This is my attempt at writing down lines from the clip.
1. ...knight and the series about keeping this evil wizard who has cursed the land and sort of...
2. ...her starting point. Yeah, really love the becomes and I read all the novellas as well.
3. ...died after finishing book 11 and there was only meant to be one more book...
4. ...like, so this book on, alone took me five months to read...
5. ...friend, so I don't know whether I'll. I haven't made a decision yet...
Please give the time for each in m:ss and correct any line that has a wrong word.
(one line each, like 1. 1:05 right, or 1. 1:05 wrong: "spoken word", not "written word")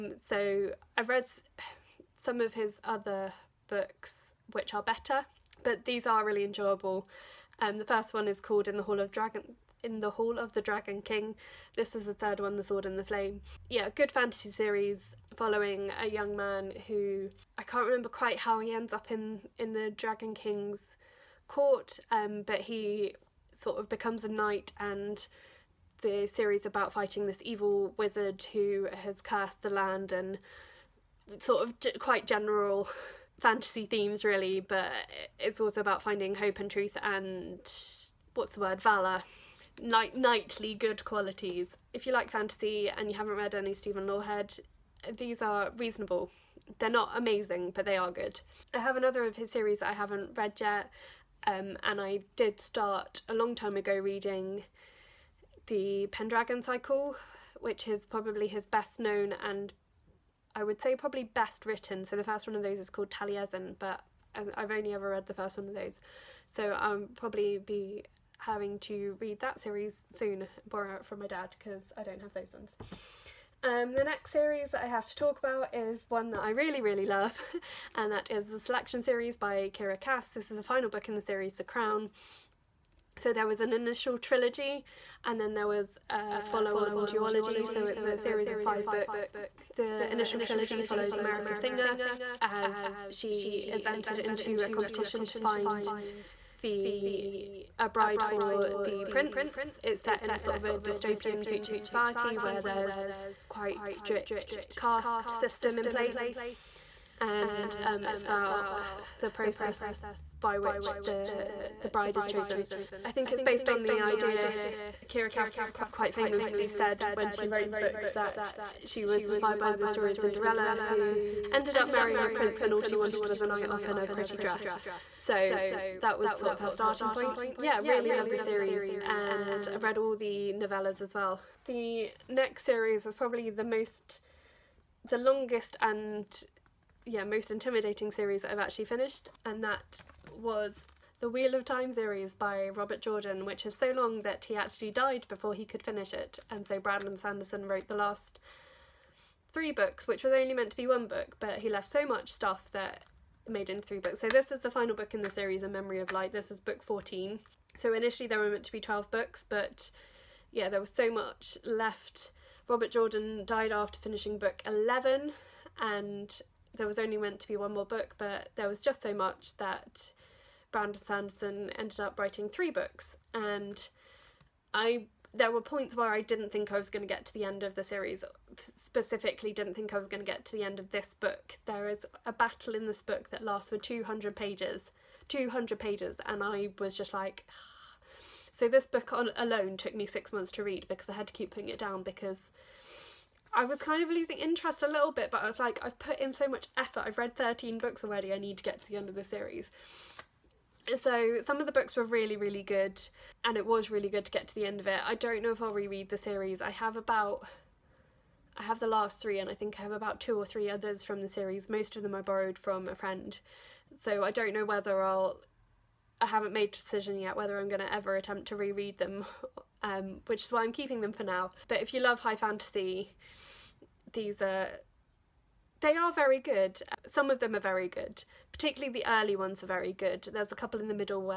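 1. 0:24 wrong: "fighting", not "keeping"
2. 2:06 wrong: "series", not "becomes"
3. 2:43 right
4. 3:07 wrong: "six", not "five"
5. 3:32 right.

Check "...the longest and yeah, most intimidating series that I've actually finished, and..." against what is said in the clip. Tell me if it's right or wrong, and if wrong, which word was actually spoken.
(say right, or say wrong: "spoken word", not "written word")
right.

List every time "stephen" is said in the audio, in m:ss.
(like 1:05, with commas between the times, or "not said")
0:43.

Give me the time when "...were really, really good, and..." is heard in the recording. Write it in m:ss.
3:21.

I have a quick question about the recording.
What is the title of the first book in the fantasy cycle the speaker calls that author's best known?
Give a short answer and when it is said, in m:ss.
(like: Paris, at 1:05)
Taliesin, at 1:03.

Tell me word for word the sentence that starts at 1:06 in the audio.
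So I'll probably be having to read that series soon, borrow it from my dad because I don't have those ones.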